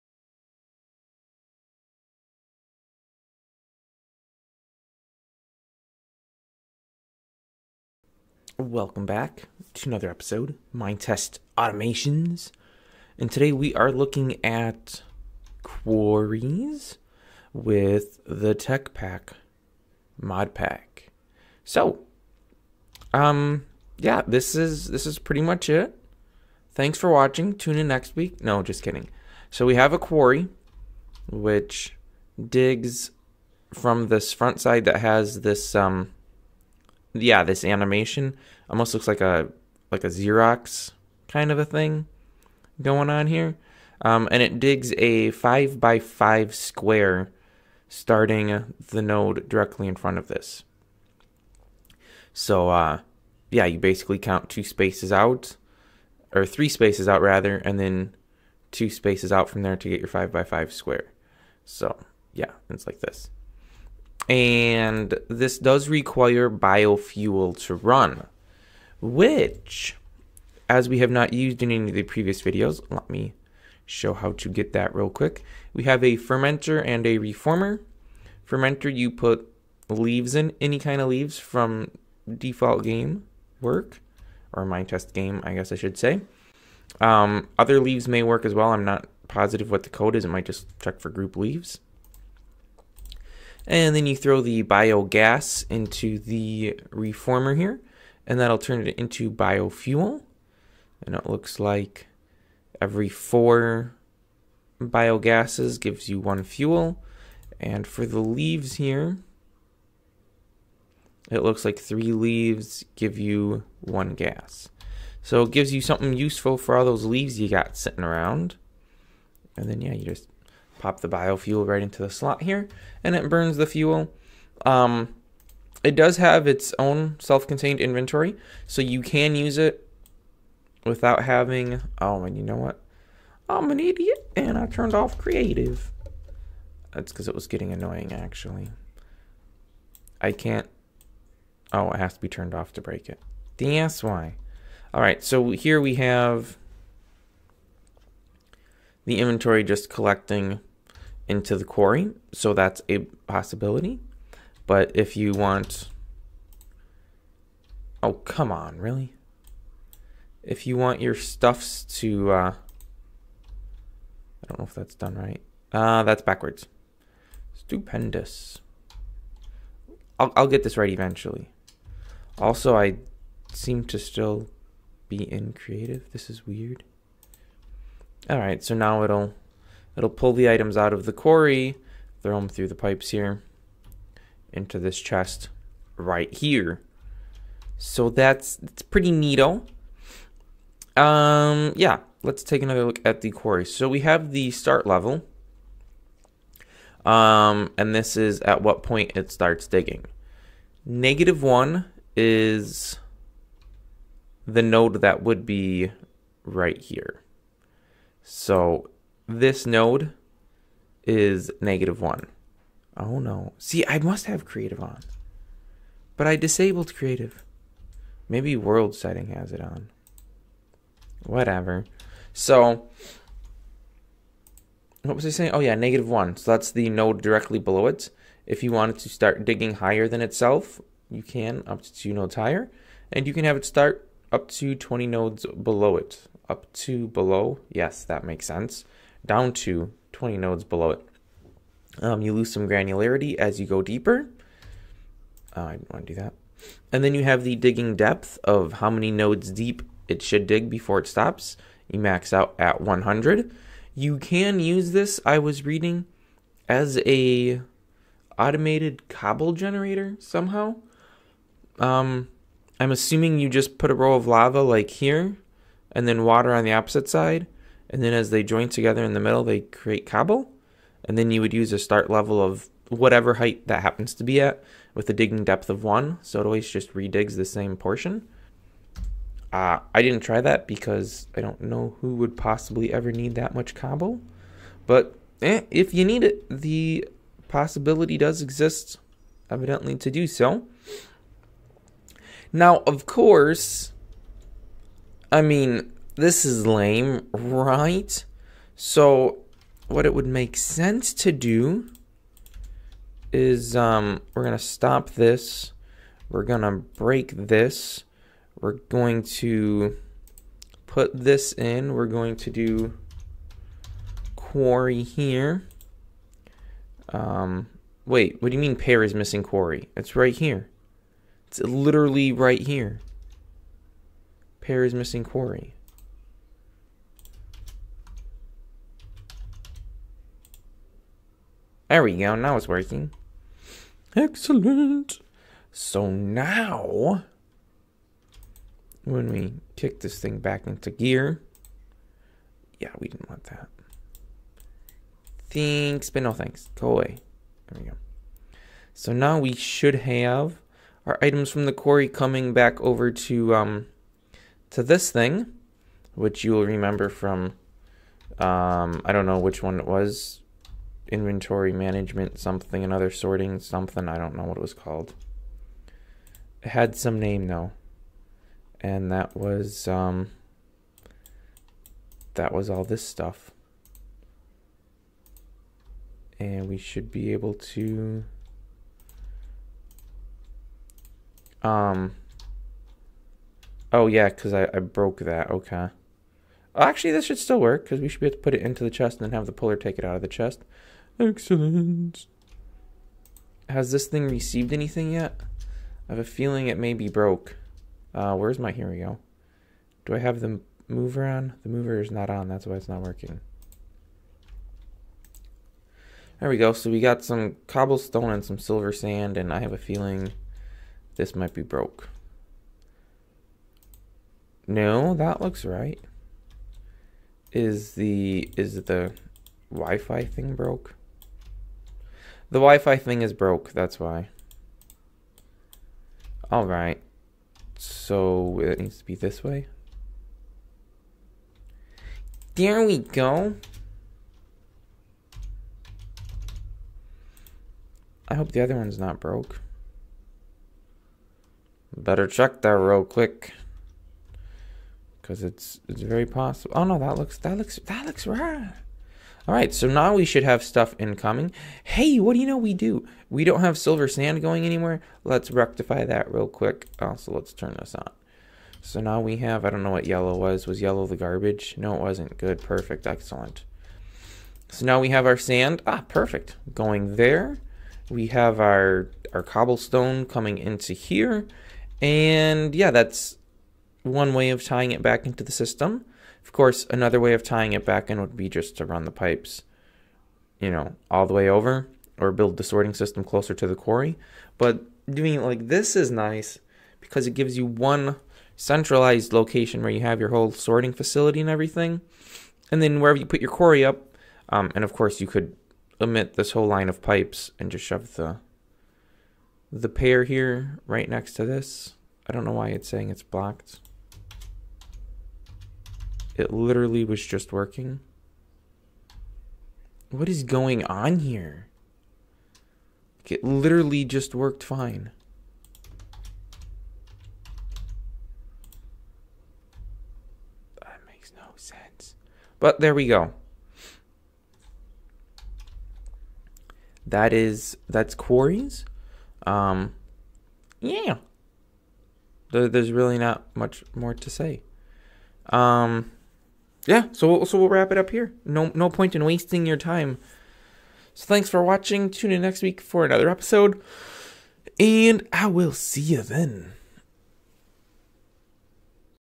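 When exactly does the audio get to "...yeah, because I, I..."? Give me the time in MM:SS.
06:24.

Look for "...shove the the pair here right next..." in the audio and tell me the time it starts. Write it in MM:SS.
08:17.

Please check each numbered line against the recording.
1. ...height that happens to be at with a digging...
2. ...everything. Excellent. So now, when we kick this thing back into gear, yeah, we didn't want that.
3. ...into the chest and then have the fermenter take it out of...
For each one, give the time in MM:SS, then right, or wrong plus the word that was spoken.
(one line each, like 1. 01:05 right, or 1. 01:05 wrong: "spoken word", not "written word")
1. 04:33 right
2. 05:32 wrong: "working", not "everything"
3. 06:28 wrong: "puller", not "fermenter".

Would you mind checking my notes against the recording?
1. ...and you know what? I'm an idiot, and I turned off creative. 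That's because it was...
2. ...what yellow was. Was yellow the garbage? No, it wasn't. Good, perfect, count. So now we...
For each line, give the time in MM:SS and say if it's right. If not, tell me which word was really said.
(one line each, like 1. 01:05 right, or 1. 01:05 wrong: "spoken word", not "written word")
1. 02:12 right
2. 07:39 wrong: "excellent", not "count".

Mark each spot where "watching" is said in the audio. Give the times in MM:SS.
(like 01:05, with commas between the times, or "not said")
00:27, 09:01.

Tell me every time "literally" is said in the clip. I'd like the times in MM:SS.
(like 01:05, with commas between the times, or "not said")
05:21, 08:26, 08:33.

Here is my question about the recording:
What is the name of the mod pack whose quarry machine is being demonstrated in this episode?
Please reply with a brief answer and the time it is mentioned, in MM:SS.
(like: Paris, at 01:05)
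Tech Pack, at 00:18.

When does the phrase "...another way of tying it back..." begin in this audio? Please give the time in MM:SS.
07:56.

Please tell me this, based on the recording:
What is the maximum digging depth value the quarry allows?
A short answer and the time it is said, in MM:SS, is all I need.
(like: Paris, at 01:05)
100, at 04:12.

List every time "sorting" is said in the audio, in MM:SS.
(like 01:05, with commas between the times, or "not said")
06:03, 08:02, 08:10.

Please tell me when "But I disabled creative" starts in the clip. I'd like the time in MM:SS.
03:36.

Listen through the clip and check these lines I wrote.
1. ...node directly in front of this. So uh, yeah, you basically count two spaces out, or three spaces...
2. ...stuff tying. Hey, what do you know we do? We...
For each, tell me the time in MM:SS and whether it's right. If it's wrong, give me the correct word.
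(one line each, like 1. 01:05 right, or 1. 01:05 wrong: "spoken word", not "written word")
1. 00:49 right
2. 07:30 wrong: "incoming", not "tying".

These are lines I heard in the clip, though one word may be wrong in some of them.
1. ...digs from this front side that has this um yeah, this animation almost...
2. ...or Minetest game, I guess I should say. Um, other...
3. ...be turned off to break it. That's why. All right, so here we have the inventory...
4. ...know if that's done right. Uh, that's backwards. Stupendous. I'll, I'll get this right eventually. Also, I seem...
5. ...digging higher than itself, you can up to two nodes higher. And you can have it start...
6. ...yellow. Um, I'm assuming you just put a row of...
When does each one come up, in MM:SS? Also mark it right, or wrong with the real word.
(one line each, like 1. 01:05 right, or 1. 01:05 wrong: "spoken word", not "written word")
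1. 00:32 right
2. 01:24 right
3. 02:22 right
4. 02:44 right
5. 03:49 right
6. 04:20 wrong: "somehow", not "yellow".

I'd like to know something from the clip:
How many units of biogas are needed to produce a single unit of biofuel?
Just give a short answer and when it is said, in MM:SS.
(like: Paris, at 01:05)
4, at 01:43.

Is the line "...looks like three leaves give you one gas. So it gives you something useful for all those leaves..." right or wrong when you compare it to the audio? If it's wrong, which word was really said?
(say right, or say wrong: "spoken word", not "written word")
right.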